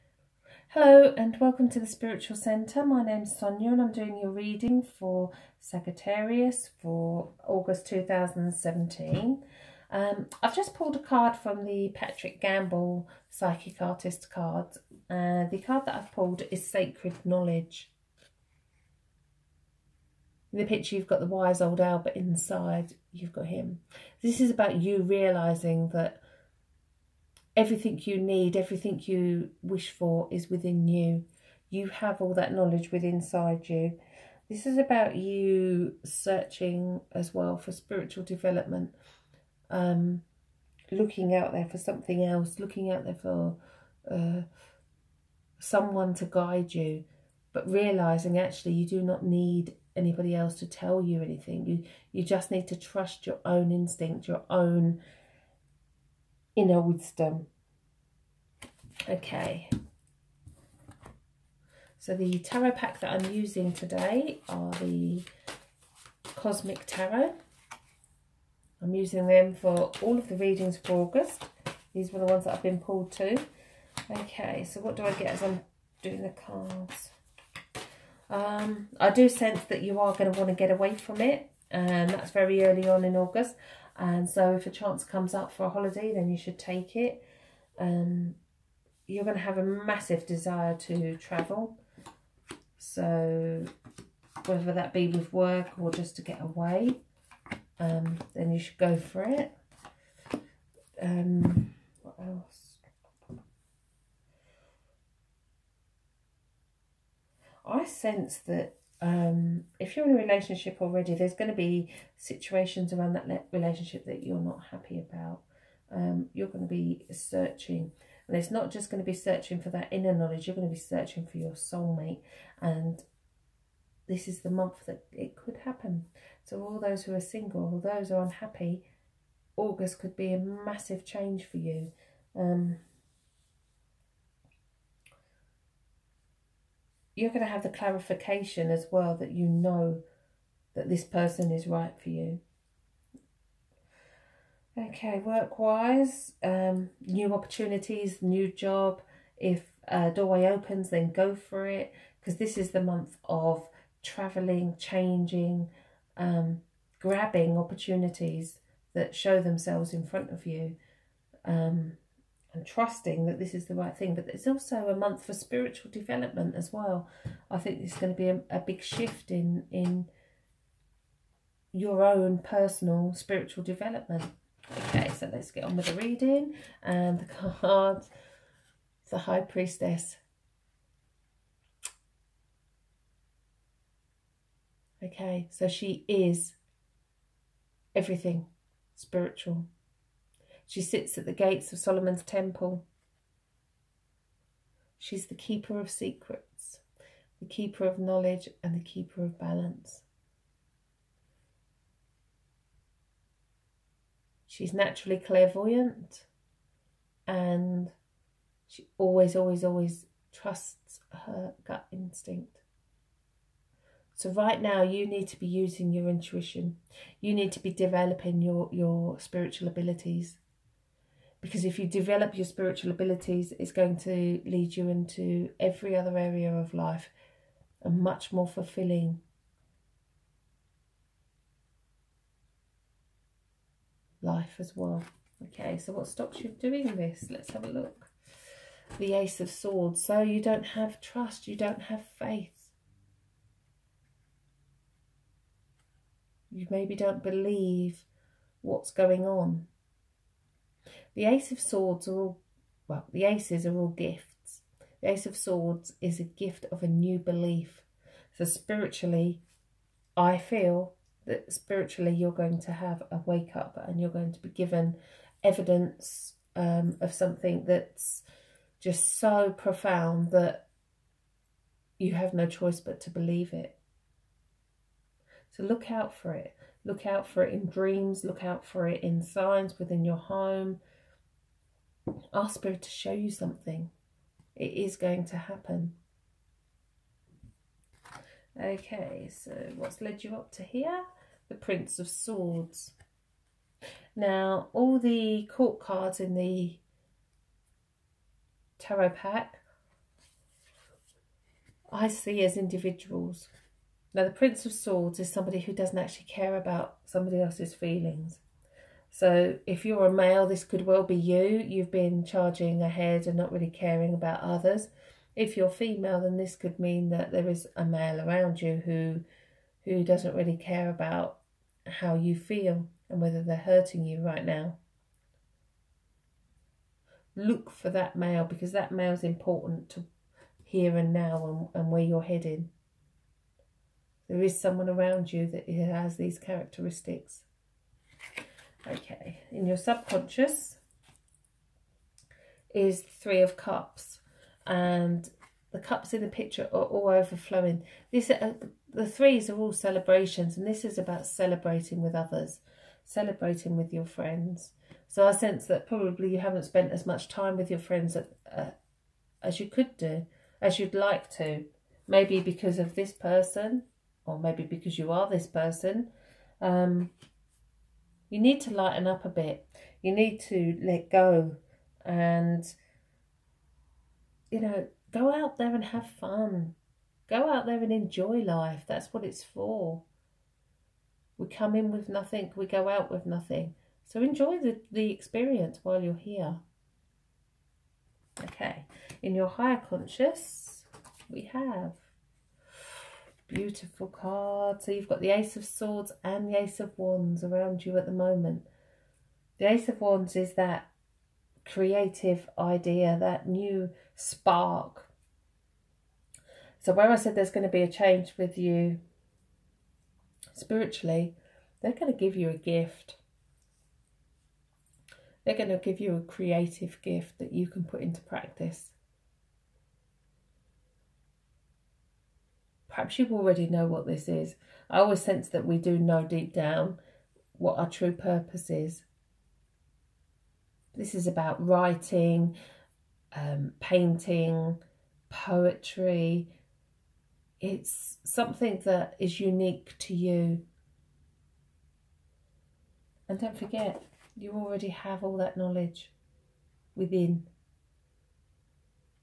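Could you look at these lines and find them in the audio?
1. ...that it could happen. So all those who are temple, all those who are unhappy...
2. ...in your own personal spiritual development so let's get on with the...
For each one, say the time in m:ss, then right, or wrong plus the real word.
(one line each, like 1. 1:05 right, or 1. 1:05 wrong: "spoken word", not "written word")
1. 2:04 wrong: "single", not "temple"
2. 2:49 right.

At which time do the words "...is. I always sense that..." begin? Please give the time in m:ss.
7:04.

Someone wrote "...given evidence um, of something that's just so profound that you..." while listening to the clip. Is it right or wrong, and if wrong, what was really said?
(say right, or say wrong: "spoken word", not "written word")
right.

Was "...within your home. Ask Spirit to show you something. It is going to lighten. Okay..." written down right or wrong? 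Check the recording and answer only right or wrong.
wrong.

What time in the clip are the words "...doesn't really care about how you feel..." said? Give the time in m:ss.
5:20.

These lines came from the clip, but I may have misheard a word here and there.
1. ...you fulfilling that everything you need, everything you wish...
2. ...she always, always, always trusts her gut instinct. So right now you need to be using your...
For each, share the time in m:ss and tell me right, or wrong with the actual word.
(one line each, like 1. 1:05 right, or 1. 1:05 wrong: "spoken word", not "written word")
1. 0:24 wrong: "realising", not "fulfilling"
2. 3:28 right.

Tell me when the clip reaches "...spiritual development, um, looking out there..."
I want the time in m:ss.
0:37.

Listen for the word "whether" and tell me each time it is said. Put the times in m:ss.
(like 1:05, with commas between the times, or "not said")
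1:34, 5:23.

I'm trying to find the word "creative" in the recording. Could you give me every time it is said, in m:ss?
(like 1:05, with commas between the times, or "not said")
6:41, 6:56.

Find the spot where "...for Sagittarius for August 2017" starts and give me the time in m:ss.
0:04.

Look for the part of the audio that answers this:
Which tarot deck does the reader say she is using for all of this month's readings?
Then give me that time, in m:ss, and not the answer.
1:06.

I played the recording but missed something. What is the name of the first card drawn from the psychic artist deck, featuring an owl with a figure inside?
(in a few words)
Sacred Knowledge.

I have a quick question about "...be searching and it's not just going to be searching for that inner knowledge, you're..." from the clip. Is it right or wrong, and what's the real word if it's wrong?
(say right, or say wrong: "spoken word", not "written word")
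right.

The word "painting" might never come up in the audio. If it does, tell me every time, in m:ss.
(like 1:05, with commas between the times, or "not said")
7:13.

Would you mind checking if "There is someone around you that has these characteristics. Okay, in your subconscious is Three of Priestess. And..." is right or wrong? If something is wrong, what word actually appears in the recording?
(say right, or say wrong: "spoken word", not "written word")
wrong: "Cups", not "Priestess".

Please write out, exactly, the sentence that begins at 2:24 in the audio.
Okay, work-wise, um, new opportunities, new job.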